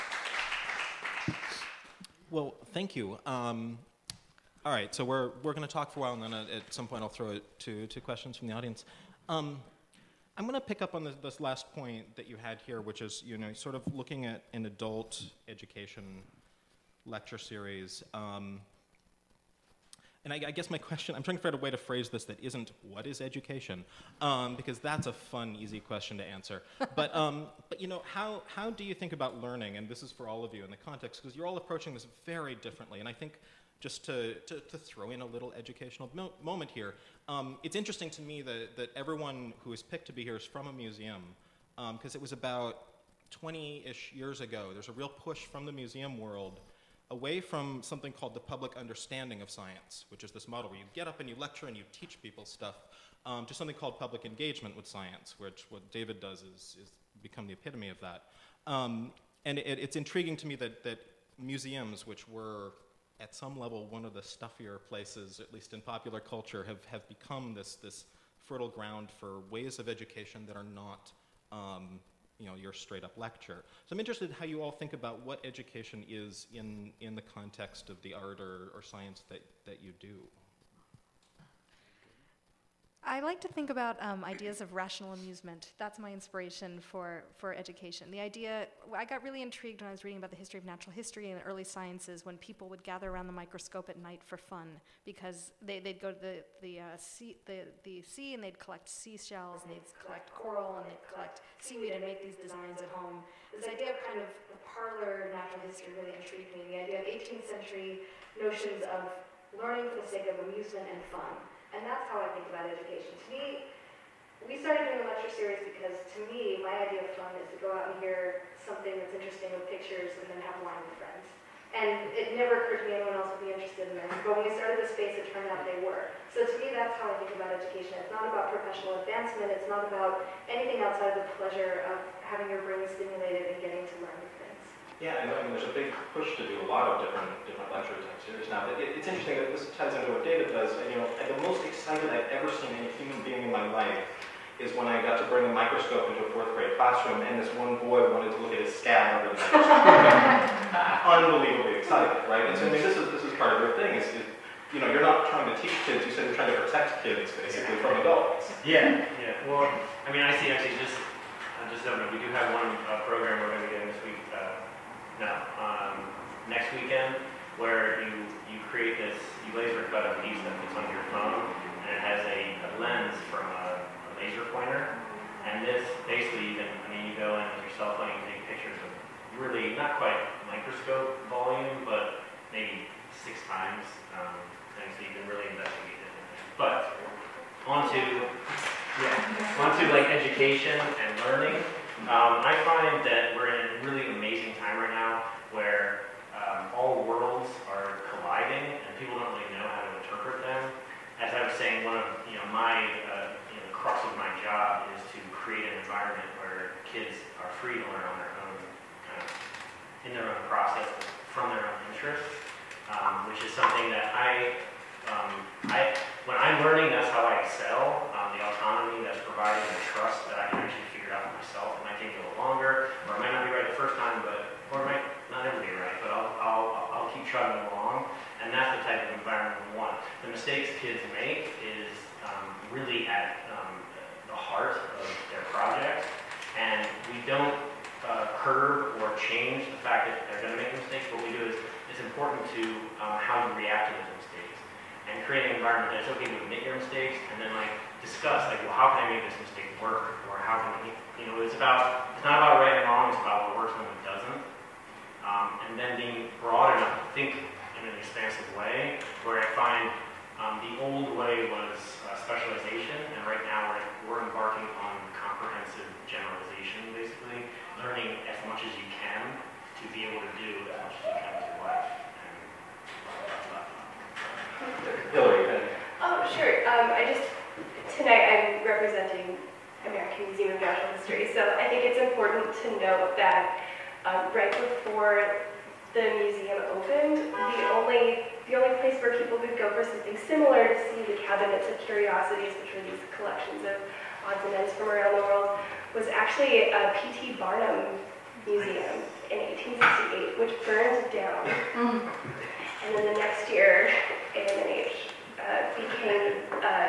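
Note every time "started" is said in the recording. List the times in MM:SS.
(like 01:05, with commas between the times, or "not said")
01:54, 02:04.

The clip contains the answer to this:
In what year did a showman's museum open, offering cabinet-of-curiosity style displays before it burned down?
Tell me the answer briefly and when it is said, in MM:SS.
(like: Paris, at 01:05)
1868, at 05:00.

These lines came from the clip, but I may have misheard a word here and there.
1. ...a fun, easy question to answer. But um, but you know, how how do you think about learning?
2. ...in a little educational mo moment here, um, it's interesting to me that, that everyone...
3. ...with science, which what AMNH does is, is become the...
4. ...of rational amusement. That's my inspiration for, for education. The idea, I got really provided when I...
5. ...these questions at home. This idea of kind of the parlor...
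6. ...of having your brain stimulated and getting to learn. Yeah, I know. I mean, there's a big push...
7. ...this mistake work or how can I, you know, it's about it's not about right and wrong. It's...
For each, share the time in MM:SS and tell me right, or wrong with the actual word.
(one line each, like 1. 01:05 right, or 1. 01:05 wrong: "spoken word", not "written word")
1. 00:25 right
2. 00:35 right
3. 00:54 wrong: "David", not "AMNH"
4. 01:24 wrong: "intrigued", not "provided"
5. 01:42 wrong: "designs", not "questions"
6. 02:11 right
7. 04:09 right.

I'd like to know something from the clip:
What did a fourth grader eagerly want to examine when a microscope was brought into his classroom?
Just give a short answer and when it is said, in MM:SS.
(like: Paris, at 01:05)
his scab, at 02:28.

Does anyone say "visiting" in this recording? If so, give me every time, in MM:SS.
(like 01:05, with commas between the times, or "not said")
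not said.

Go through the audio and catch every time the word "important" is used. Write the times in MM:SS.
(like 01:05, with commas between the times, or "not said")
04:02, 04:41.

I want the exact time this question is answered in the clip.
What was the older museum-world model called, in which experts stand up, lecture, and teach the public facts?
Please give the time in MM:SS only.
00:48.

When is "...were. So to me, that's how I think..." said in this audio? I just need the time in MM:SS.
02:05.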